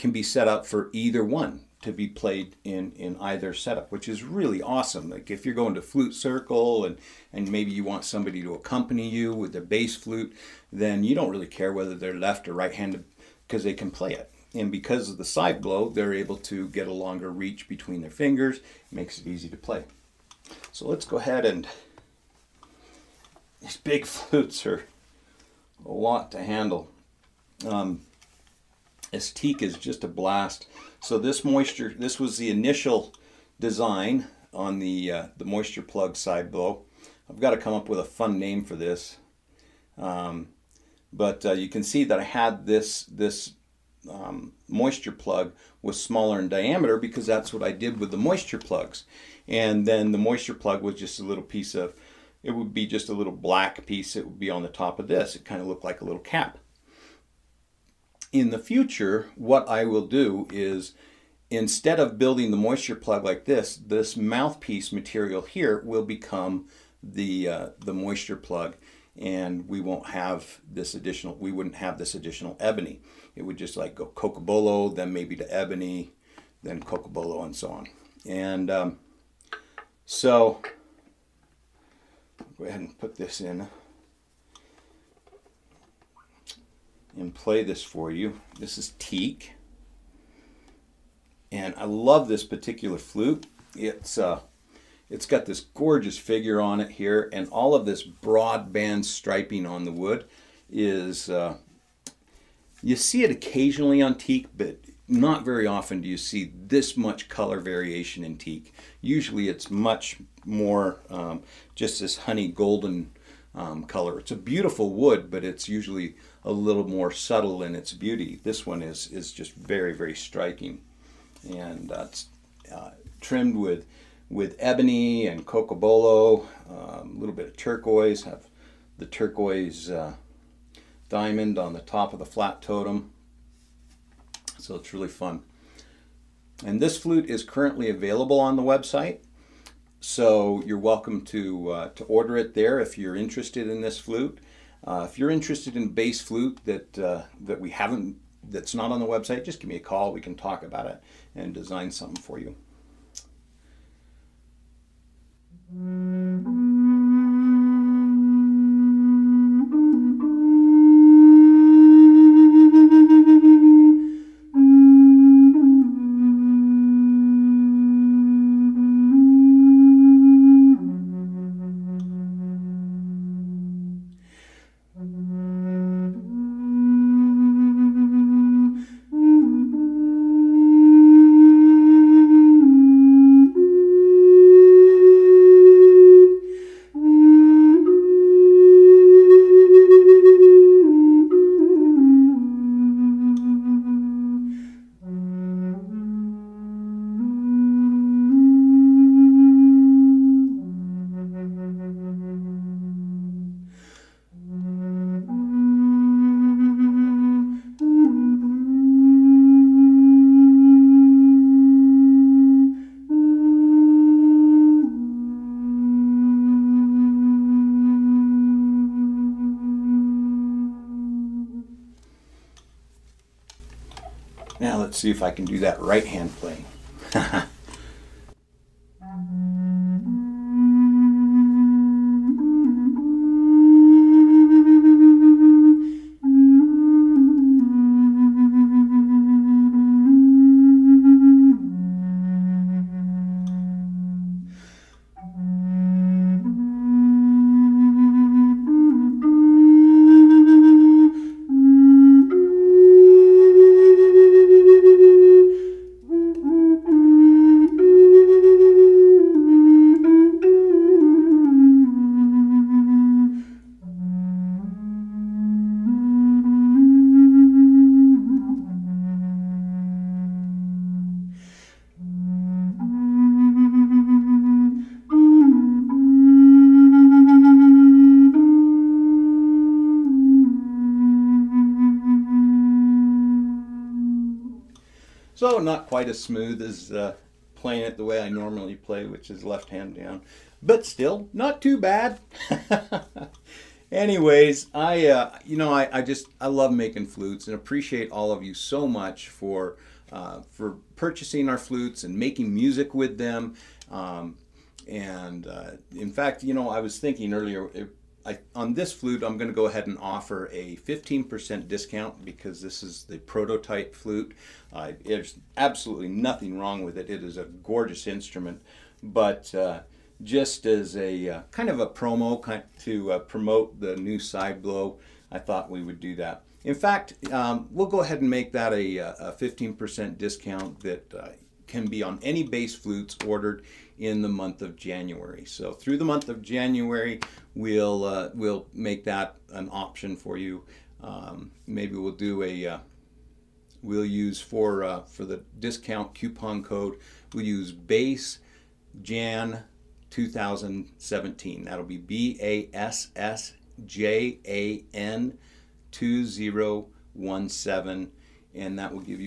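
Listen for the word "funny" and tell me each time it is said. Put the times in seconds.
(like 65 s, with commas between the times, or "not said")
not said.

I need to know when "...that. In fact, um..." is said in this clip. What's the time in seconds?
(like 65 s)
326 s.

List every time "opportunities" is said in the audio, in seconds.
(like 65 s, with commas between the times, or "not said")
not said.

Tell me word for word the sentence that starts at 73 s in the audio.
It would just like go cocobolo, then maybe to ebony, then cocobolo and so on.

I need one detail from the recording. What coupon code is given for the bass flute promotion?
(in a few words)
BASSJAN2017.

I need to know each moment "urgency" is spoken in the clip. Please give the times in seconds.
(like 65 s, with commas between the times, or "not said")
not said.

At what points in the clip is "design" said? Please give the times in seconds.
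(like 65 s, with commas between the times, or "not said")
33 s, 151 s.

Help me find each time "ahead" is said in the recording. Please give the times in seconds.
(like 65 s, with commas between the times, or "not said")
21 s, 82 s, 309 s, 328 s.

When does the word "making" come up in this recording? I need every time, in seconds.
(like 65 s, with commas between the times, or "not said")
296 s, 302 s.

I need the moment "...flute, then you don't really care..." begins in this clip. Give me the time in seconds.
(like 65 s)
9 s.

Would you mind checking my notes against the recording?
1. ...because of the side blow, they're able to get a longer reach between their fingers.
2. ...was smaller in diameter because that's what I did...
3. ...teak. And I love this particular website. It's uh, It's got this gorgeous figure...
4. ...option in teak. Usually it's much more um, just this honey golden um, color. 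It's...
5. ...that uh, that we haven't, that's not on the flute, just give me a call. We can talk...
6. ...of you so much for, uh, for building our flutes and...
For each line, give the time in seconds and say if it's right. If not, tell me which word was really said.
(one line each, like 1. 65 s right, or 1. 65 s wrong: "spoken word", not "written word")
1. 14 s right
2. 45 s right
3. 88 s wrong: "flute", not "website"
4. 107 s wrong: "variation", not "option"
5. 146 s wrong: "website", not "flute"
6. 298 s wrong: "purchasing", not "building".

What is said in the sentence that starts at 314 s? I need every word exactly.
Uh, there's absolutely nothing wrong with it.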